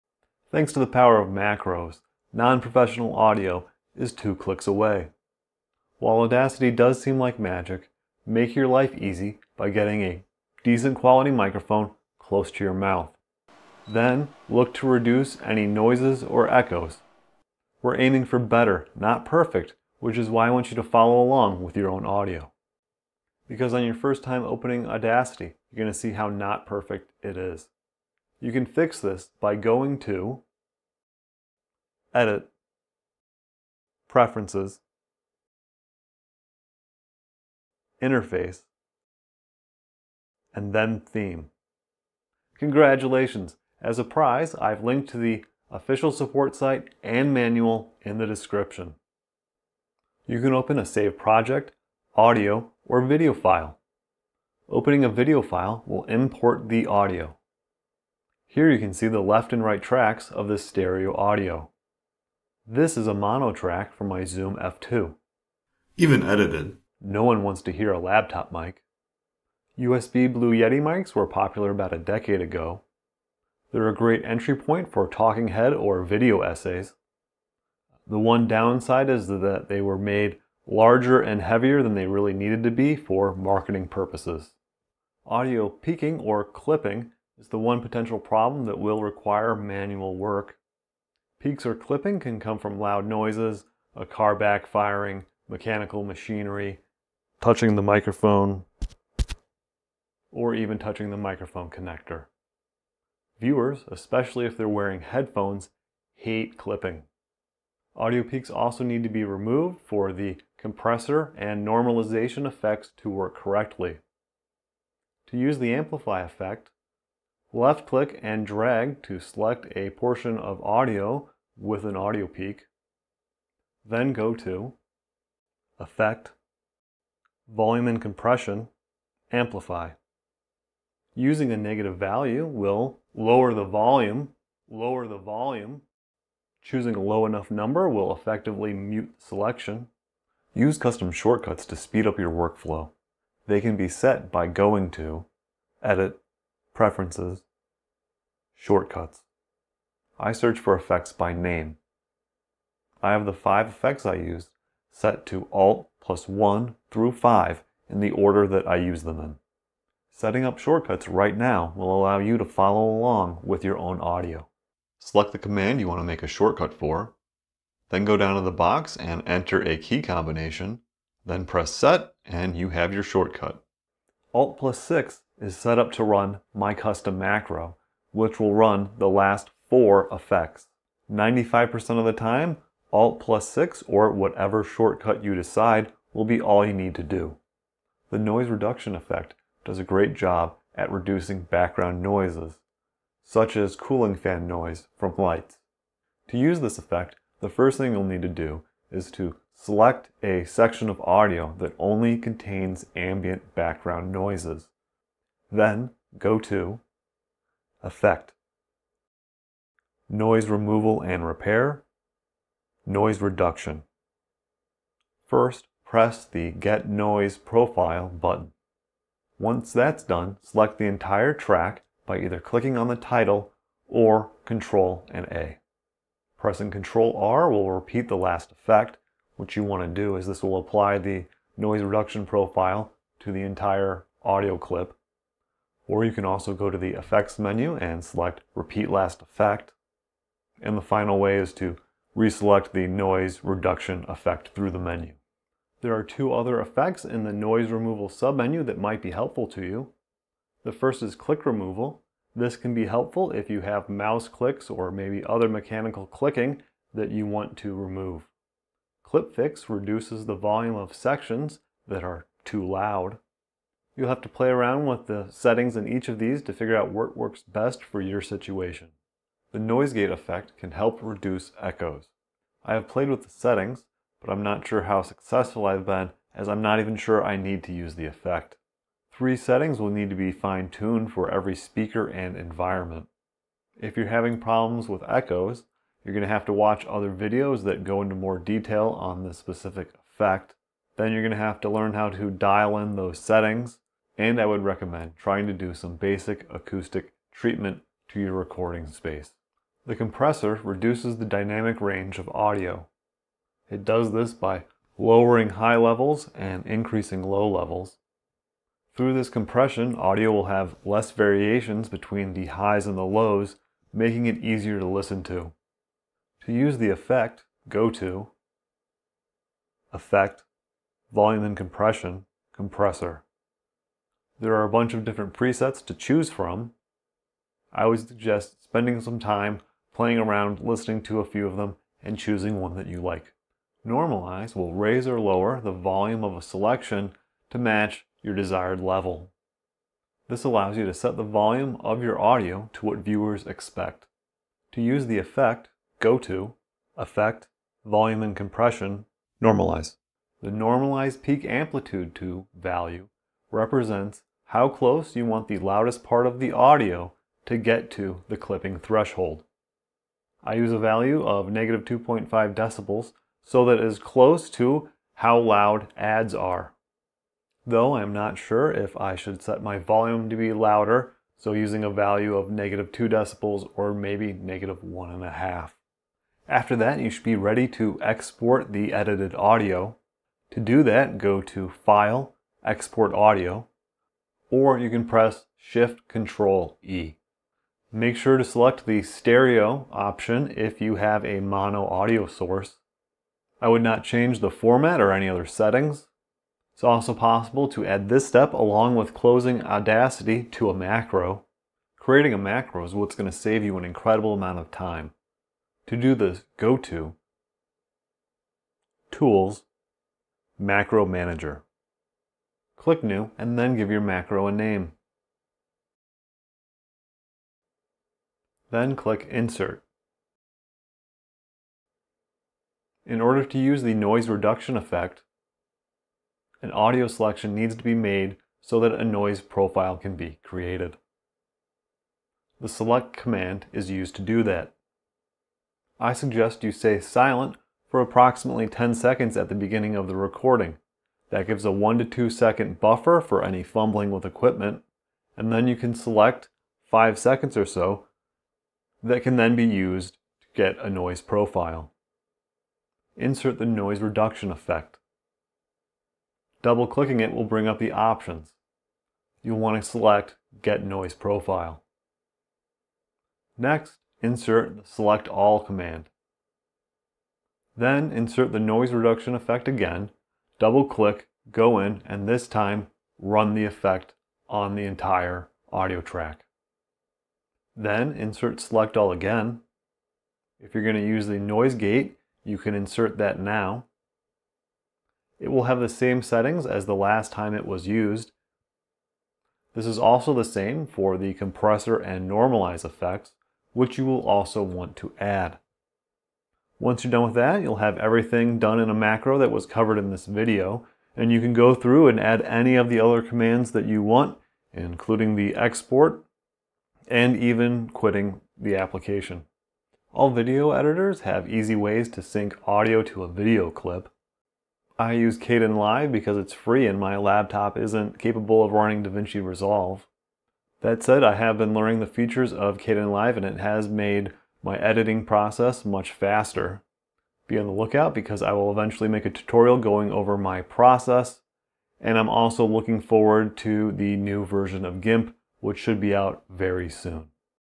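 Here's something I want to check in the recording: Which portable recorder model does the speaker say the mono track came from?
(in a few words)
Zoom F2.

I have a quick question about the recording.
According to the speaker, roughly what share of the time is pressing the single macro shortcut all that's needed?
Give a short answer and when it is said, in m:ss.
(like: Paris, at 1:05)
95%, at 3:01.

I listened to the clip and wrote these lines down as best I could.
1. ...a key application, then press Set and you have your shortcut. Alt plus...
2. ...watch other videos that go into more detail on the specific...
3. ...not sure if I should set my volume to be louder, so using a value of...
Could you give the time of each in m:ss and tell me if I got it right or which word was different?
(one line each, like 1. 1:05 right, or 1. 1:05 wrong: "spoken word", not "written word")
1. 2:49 wrong: "combination", not "application"
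2. 4:46 right
3. 6:08 right.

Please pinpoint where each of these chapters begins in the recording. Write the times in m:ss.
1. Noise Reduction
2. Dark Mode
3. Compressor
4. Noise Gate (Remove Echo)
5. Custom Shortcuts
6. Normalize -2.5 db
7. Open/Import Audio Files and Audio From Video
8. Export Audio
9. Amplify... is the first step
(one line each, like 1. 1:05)
1. 3:07
2. 0:22
3. 4:59
4. 4:28
5. 2:20
6. 5:33
7. 0:49
8. 6:16
9. 1:24.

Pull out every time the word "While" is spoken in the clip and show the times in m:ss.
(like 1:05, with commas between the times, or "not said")
0:05.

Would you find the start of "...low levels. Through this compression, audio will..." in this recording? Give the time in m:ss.
5:07.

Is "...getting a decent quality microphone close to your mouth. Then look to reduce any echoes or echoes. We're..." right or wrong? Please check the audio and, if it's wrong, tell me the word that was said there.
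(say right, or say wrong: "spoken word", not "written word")
wrong: "noises", not "echoes".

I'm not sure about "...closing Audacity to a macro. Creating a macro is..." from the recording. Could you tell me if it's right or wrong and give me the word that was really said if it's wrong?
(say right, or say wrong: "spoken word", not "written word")
right.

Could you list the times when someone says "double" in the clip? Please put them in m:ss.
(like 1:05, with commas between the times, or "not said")
7:36, 7:50.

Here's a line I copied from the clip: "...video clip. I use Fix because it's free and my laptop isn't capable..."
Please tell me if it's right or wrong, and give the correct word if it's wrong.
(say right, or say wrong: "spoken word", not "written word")
wrong: "Kdenlive", not "Fix".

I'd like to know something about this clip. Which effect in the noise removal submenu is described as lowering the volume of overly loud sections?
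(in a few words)
Clip Fix.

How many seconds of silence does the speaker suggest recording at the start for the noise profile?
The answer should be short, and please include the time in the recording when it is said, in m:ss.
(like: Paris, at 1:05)
10, at 7:18.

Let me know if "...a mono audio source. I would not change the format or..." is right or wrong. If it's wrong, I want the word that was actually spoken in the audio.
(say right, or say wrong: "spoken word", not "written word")
right.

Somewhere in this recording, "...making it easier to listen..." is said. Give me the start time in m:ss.
5:13.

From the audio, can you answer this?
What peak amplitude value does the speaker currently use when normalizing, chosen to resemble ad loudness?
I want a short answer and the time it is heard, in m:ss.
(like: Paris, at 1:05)
-2.5 dB, at 6:01.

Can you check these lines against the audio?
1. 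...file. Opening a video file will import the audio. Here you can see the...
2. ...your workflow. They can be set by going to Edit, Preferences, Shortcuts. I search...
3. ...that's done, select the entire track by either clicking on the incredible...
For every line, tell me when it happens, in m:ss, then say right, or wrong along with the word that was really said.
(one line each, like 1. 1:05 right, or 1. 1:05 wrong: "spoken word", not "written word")
1. 0:53 right
2. 2:22 right
3. 3:39 wrong: "title", not "incredible".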